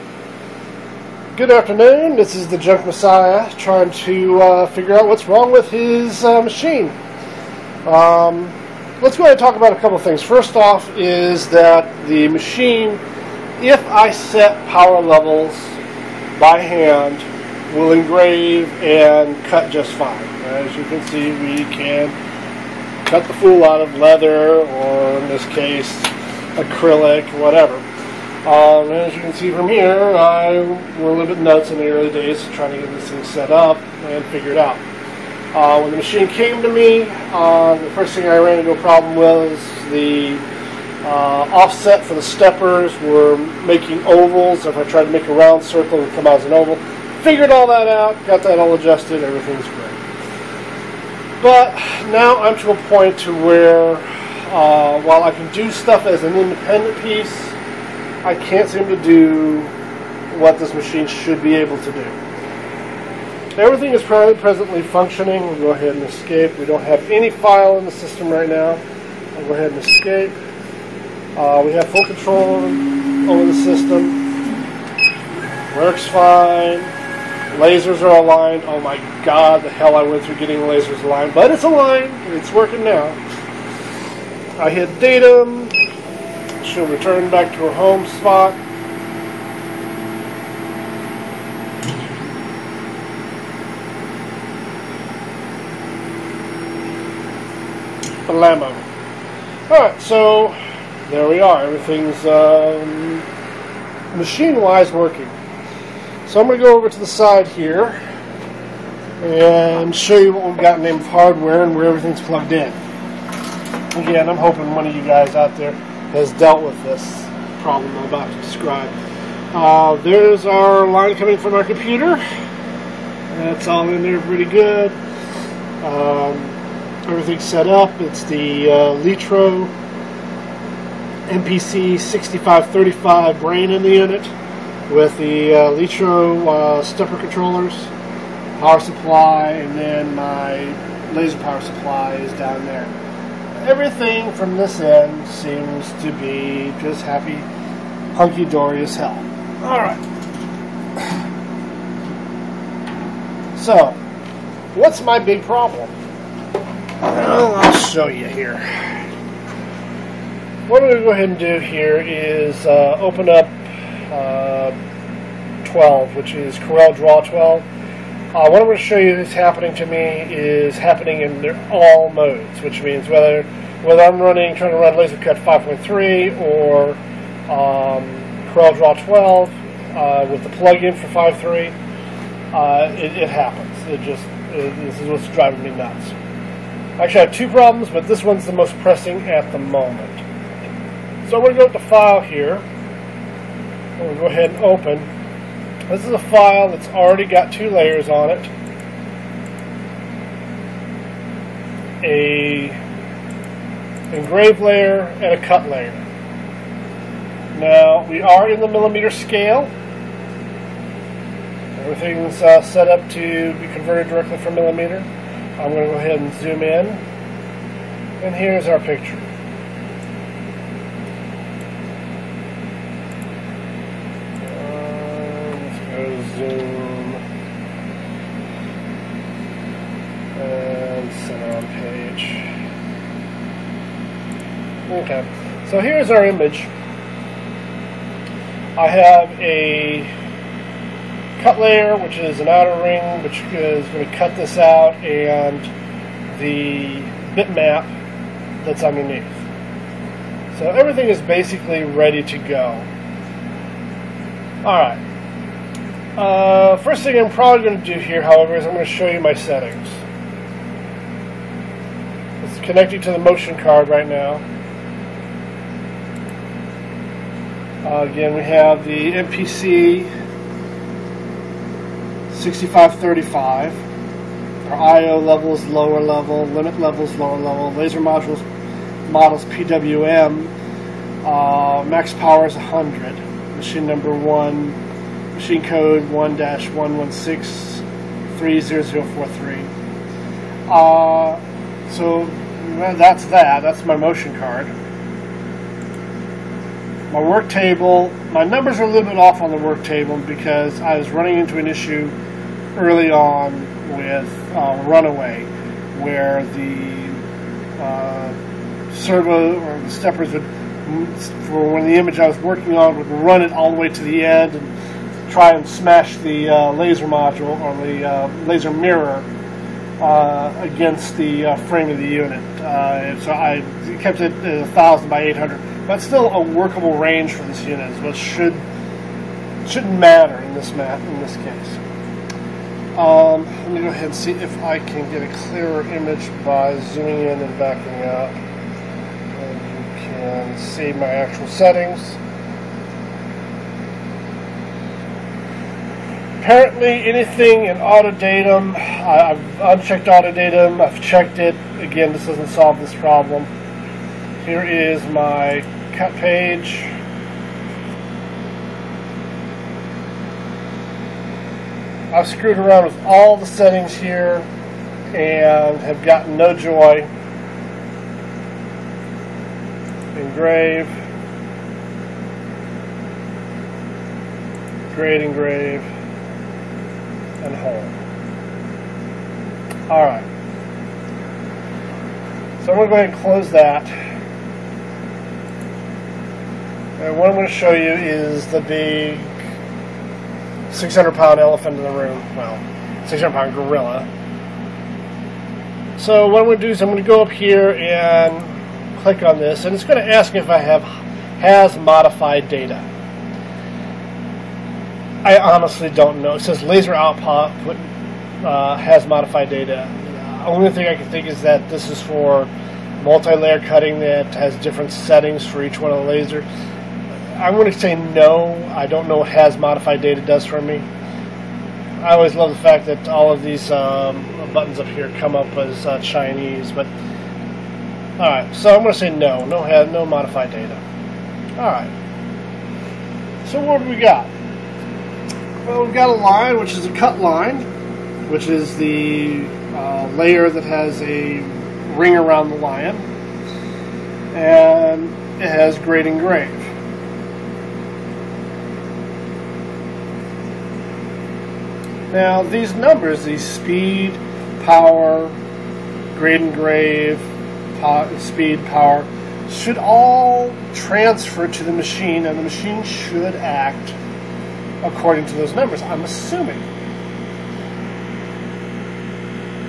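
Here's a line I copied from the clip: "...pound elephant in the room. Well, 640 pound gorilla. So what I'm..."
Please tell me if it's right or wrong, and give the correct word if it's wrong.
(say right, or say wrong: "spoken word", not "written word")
wrong: "600", not "640".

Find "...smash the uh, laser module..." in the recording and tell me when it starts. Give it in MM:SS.
05:15.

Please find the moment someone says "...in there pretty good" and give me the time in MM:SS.
02:03.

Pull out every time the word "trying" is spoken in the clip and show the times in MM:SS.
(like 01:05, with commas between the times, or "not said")
00:03, 00:32, 02:54.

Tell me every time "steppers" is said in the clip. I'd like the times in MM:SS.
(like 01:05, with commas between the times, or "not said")
00:42, 02:16, 05:09.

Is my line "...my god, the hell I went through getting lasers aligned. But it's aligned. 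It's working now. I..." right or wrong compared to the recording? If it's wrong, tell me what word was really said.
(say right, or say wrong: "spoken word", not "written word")
right.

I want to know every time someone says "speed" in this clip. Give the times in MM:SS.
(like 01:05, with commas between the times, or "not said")
07:33, 07:38.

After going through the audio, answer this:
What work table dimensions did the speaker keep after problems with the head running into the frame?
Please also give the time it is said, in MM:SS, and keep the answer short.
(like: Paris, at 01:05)
1,000 by 800, at 05:24.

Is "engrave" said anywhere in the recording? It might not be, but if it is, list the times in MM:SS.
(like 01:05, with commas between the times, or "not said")
00:17, 03:24, 06:10, 06:15, 07:26, 07:36.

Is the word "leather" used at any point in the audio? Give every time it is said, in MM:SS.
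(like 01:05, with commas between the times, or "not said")
00:23.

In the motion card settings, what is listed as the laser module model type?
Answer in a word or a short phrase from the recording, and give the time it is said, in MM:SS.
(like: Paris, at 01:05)
PWM, at 04:39.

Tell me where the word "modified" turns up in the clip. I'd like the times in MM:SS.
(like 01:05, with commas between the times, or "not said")
06:41, 06:49, 06:59, 07:10.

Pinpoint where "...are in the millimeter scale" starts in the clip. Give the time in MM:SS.
03:28.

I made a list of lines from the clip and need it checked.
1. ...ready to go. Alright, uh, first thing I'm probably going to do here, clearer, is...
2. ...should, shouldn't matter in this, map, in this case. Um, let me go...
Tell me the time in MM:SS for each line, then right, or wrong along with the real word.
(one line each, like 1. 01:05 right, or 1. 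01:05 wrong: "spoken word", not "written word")
1. 04:11 wrong: "however", not "clearer"
2. 05:28 right.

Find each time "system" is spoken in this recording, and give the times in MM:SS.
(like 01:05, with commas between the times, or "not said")
01:07, 01:13.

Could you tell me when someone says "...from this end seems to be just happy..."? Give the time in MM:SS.
02:24.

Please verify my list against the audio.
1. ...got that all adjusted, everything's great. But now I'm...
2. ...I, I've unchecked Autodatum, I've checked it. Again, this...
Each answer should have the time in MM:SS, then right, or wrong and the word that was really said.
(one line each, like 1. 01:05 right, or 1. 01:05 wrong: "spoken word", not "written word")
1. 00:48 right
2. 05:48 right.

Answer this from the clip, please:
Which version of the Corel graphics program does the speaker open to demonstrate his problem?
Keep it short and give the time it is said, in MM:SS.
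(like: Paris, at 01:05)
CorelDRAW 12, at 02:46.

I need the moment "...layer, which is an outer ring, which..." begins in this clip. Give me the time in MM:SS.
04:01.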